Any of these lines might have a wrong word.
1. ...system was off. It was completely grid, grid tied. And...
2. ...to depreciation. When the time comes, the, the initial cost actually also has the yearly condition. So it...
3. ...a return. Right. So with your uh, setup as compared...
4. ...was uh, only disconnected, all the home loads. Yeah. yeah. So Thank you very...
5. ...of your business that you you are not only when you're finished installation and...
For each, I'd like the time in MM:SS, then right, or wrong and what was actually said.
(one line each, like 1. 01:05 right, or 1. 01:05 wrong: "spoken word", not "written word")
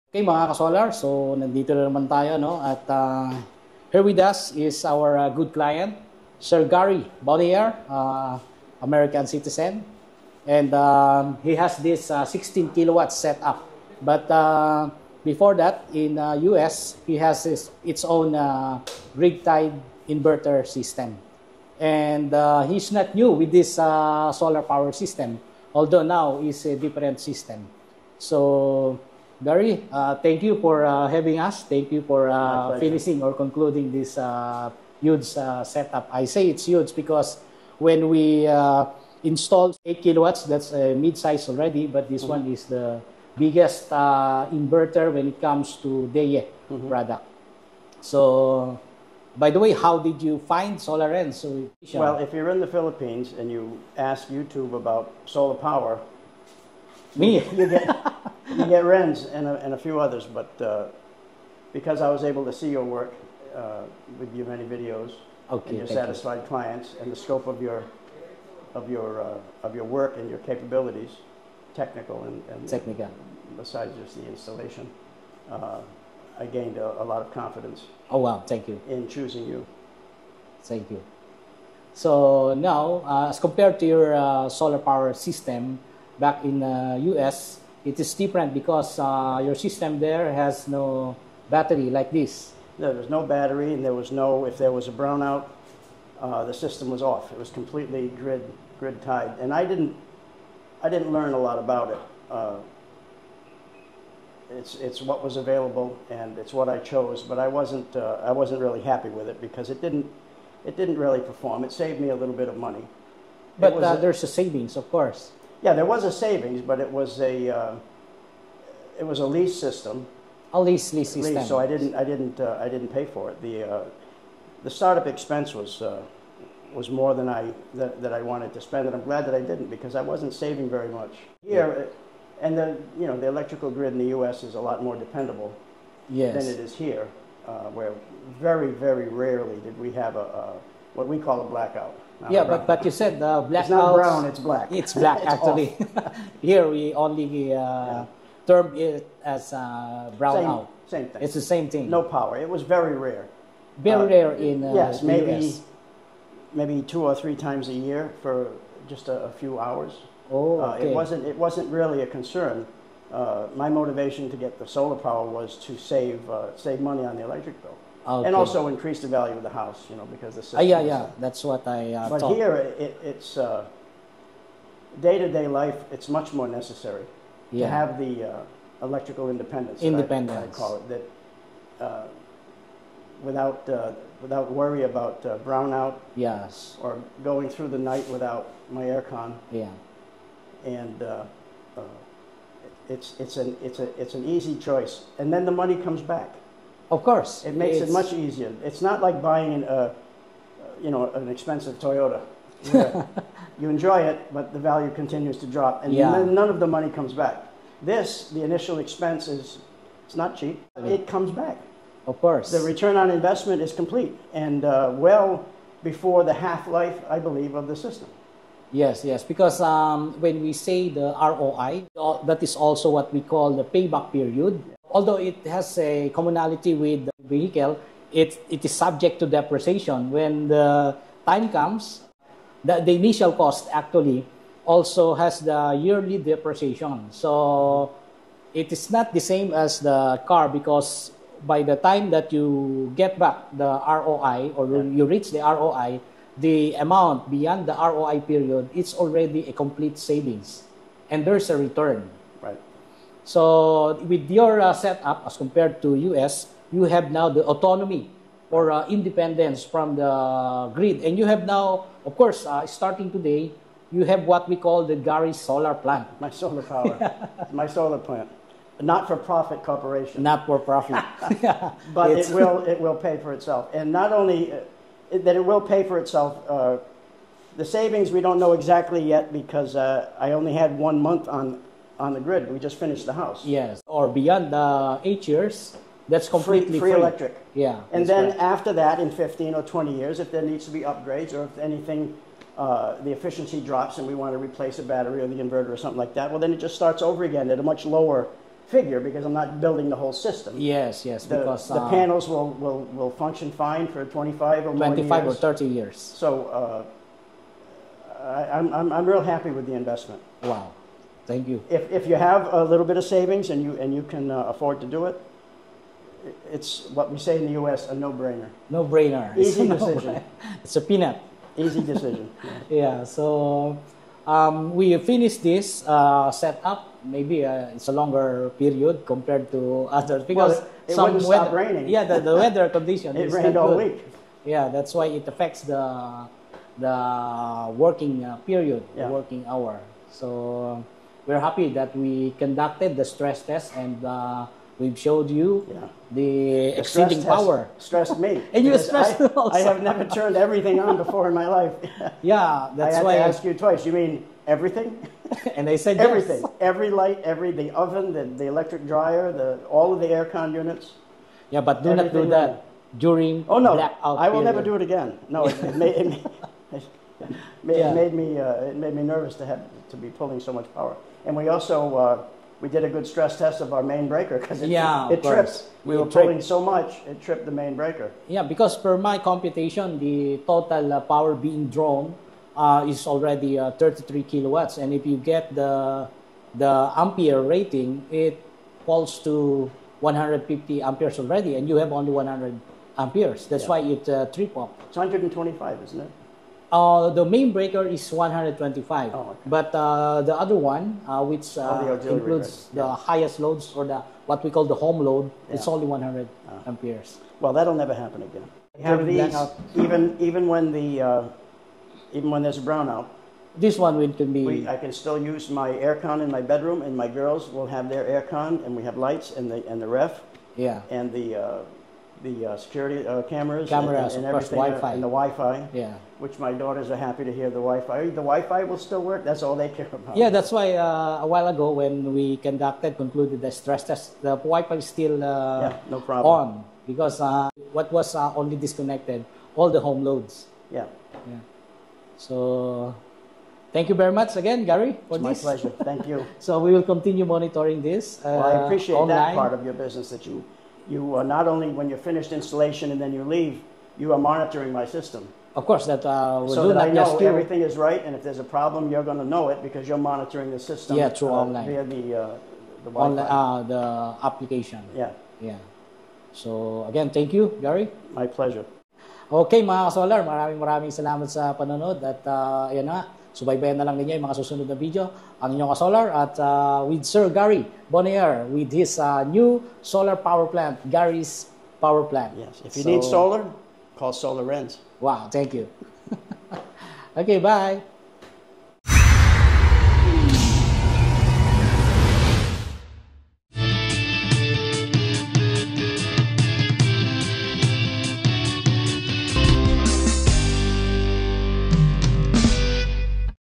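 1. 01:36 right
2. 03:49 wrong: "depreciation", not "condition"
3. 04:11 right
4. 07:17 right
5. 07:29 right.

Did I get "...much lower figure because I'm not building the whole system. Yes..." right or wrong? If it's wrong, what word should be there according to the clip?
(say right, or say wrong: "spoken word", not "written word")
right.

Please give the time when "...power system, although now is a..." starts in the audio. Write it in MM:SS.
00:24.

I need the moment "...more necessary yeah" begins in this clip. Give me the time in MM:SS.
02:56.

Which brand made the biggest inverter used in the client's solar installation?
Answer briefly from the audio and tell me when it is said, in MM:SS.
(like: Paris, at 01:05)
Deye, at 00:46.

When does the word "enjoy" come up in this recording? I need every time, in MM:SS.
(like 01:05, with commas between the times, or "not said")
03:23.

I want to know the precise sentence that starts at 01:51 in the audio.
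It saved me a little bit of money.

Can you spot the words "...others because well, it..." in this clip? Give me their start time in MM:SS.
05:29.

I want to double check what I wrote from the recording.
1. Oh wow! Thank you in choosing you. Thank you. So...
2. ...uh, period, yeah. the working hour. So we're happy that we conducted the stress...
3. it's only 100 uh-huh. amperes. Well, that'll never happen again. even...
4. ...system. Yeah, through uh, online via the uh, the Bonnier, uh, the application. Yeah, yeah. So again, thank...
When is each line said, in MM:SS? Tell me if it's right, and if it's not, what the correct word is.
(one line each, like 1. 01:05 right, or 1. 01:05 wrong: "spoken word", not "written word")
1. 01:18 right
2. 05:38 right
3. 06:45 right
4. 07:40 wrong: "Online", not "Bonnier".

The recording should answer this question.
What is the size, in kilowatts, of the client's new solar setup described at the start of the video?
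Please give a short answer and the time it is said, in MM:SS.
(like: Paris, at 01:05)
16 kilowatts, at 00:12.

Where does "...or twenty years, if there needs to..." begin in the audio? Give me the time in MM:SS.
04:49.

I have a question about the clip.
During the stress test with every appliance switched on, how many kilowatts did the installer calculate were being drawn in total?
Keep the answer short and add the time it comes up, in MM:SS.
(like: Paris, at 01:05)
33 kilowatts, at 06:23.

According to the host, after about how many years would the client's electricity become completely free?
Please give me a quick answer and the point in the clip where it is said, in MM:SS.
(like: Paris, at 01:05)
8 years, at 04:45.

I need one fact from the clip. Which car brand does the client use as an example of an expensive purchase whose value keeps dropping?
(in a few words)
Toyota.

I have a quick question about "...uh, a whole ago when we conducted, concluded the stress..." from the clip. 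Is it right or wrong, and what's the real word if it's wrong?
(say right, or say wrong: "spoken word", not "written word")
wrong: "while", not "whole".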